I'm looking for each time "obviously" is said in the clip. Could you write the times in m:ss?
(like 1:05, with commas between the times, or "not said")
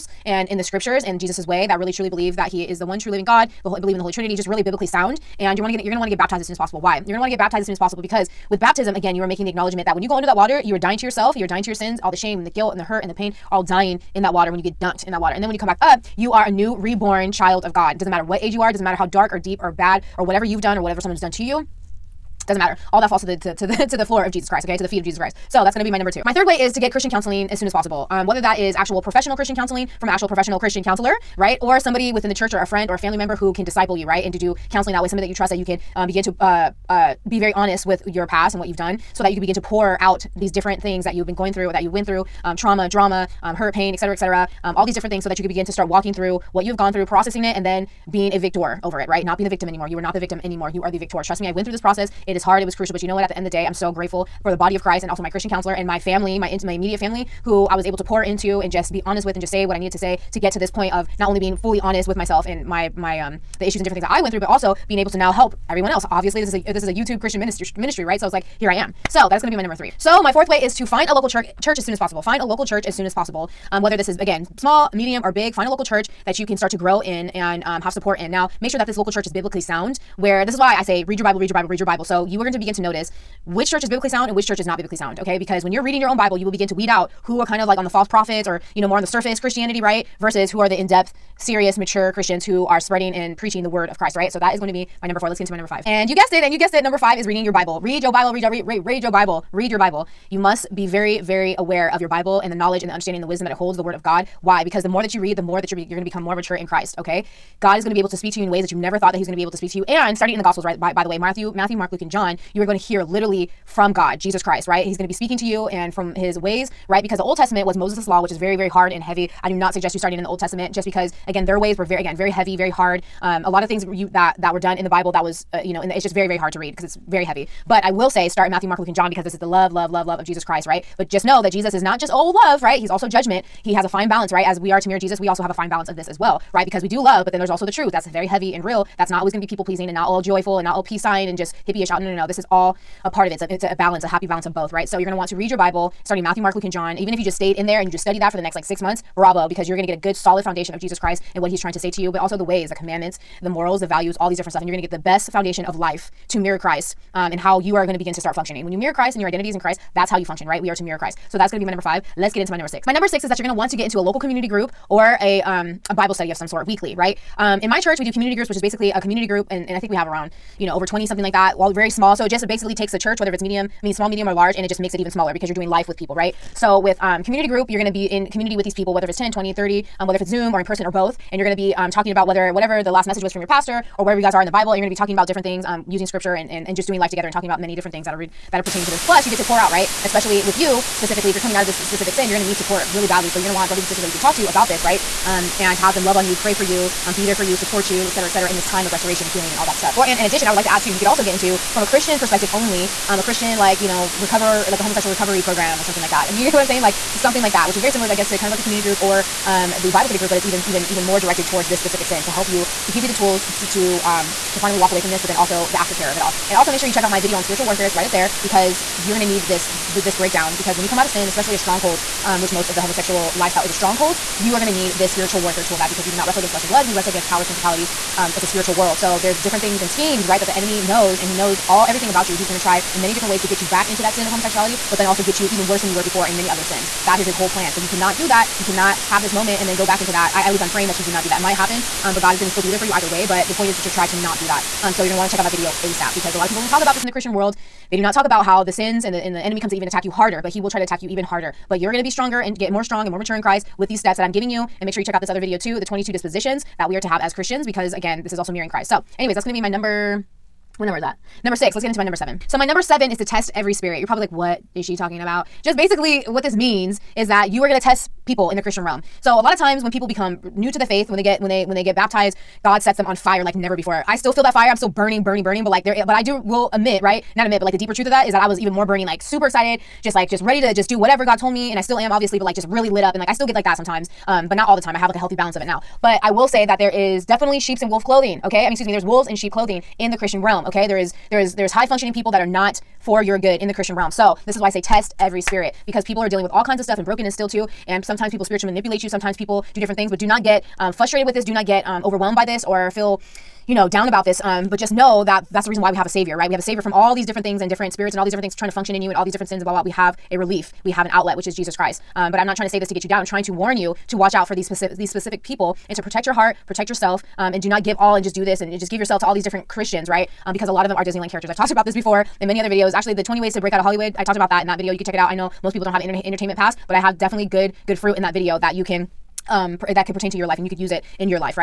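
1:06, 4:42.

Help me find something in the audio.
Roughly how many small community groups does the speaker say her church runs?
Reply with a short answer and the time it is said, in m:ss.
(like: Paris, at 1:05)
over 20, at 2:50.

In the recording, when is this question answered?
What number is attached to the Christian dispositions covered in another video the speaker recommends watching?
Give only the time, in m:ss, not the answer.
4:15.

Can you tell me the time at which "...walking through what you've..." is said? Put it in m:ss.
0:45.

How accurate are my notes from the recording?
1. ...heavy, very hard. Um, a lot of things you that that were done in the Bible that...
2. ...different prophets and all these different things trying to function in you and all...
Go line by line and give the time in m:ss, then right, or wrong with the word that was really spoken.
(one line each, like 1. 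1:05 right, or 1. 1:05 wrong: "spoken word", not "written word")
1. 2:02 right
2. 5:07 wrong: "spirits", not "prophets".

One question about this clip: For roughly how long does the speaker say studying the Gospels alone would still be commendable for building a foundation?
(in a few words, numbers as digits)
6 months.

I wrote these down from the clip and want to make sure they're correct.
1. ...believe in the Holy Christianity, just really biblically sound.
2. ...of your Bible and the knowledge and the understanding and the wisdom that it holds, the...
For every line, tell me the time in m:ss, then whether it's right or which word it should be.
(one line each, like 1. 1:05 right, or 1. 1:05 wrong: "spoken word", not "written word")
1. 0:03 wrong: "Trinity", not "Christianity"
2. 1:41 right.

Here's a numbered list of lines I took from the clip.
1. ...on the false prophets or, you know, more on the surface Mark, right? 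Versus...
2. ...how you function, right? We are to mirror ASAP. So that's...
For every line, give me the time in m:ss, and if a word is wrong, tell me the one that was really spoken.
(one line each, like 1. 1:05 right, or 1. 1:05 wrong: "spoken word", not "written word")
1. 1:27 wrong: "Christianity", not "Mark"
2. 2:40 wrong: "Christ", not "ASAP".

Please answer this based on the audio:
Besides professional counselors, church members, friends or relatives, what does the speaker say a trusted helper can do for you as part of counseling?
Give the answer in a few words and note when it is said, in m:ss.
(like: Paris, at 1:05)
disciple you, at 0:33.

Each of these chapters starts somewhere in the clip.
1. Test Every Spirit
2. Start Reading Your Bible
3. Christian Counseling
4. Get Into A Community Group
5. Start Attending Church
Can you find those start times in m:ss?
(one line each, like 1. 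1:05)
1. 4:22
2. 1:36
3. 0:30
4. 2:43
5. 1:10.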